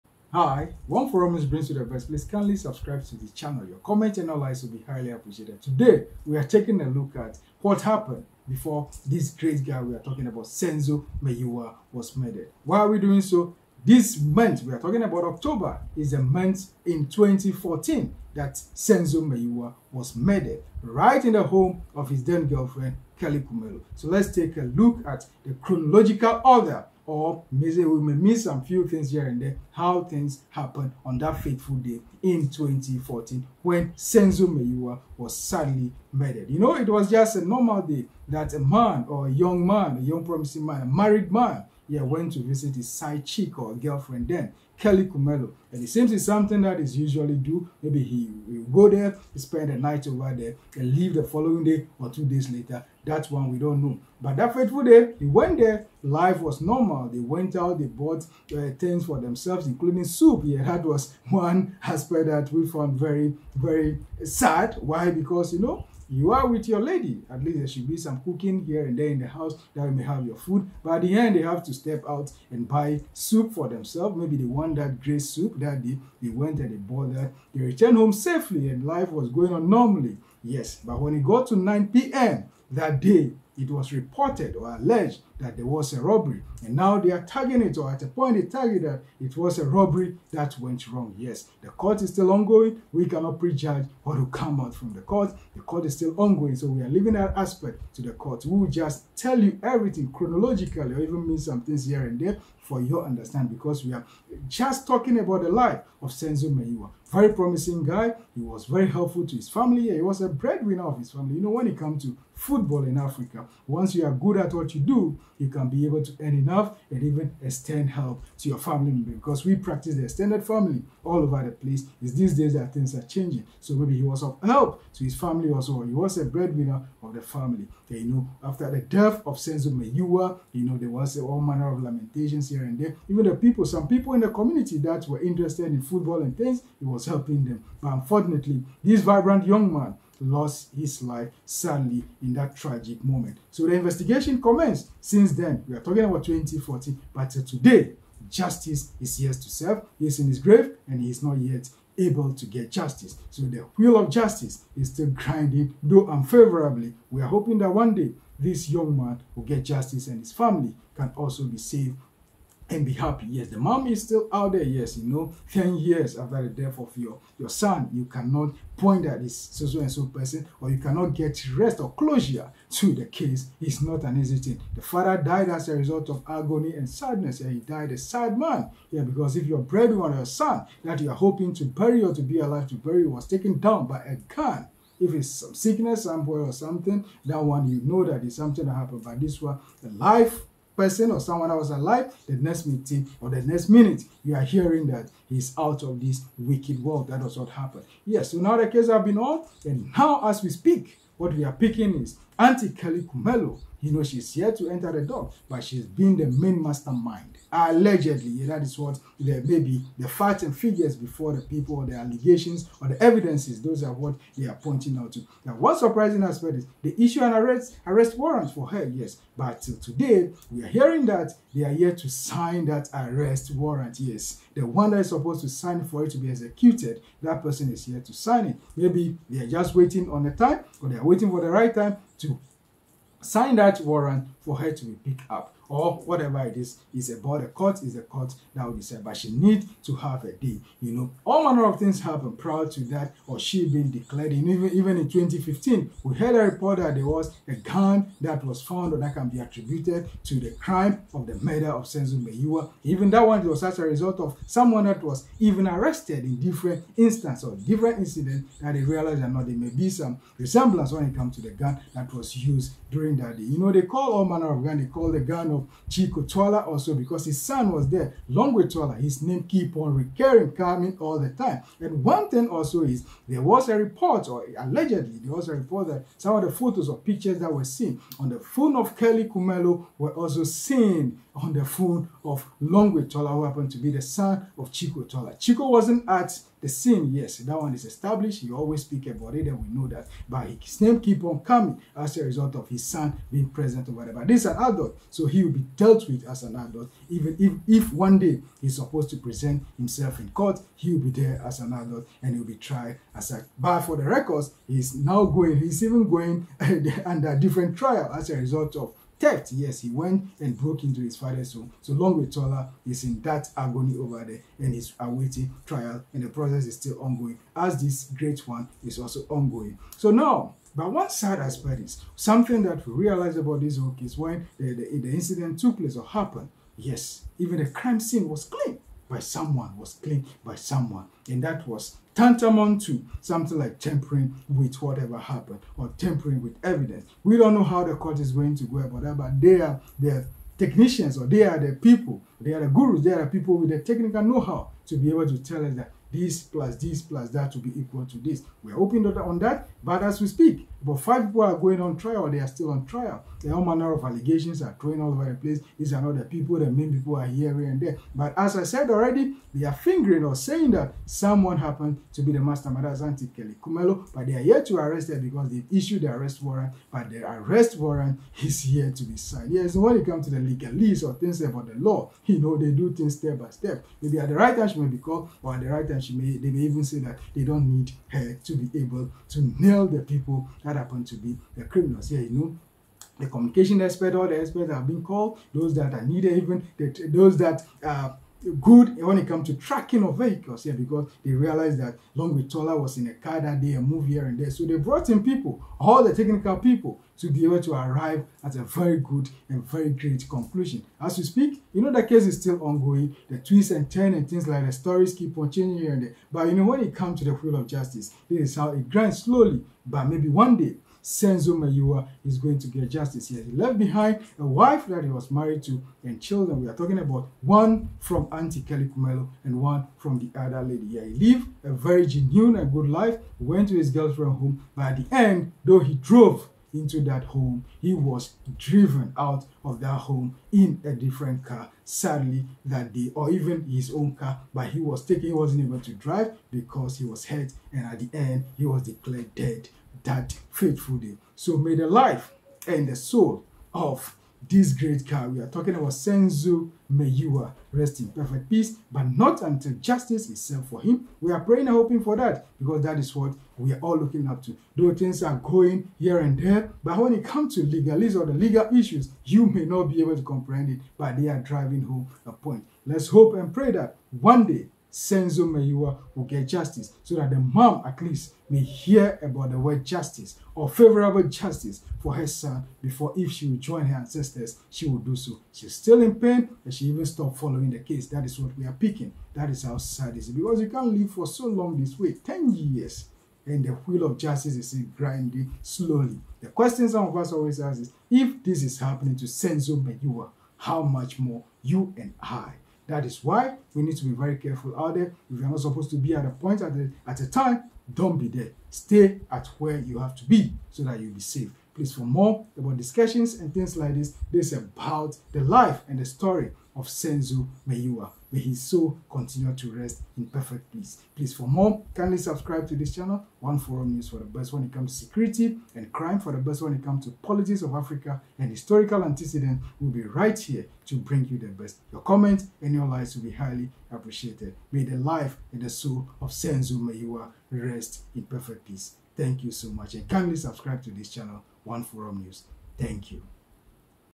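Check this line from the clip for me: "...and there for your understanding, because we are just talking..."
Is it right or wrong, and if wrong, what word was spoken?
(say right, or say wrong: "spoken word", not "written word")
right.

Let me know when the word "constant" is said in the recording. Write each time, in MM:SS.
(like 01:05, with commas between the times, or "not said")
not said.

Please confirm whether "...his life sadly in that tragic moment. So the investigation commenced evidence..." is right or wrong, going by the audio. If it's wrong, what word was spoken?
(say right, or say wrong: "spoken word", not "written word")
wrong: "since", not "evidence".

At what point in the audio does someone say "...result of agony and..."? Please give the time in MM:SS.
02:55.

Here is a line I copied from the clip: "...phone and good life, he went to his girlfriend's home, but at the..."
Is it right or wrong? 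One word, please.
wrong.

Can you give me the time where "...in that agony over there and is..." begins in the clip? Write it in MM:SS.
05:13.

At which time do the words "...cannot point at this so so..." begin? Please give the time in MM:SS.
02:48.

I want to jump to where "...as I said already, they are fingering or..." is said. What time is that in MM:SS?
05:58.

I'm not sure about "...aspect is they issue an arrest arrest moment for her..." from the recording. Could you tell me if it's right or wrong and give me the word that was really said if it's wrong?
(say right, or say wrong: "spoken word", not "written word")
wrong: "warrant", not "moment".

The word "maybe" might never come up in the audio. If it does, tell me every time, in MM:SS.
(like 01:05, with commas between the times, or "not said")
00:27, 00:47, 01:14, 02:03, 03:29, 03:48, 06:14, 06:50.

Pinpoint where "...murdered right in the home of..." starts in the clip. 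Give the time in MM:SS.
00:20.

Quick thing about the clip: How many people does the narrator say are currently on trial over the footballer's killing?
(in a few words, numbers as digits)
5.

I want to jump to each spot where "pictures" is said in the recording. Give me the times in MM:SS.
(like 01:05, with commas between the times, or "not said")
04:36.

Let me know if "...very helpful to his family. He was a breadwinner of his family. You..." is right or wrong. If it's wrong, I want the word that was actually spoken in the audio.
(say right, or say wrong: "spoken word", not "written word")
right.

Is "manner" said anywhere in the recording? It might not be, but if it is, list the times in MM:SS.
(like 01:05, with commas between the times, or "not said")
02:11, 04:01, 04:24, 05:53.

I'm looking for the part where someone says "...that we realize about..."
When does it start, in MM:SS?
05:22.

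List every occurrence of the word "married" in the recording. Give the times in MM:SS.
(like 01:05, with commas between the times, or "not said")
00:40, 06:55.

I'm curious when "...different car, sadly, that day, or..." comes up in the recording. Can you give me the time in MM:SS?
07:10.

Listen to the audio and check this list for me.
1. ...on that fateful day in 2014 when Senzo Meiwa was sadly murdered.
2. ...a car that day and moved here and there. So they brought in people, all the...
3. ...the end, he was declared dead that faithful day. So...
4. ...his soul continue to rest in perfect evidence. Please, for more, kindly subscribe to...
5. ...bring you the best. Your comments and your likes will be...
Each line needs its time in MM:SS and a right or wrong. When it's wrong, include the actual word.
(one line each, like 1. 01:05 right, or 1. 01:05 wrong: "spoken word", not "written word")
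1. 00:31 right
2. 06:33 right
3. 07:17 right
4. 08:28 wrong: "peace", not "evidence"
5. 08:40 right.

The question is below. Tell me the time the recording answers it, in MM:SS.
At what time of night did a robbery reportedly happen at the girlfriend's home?
01:21.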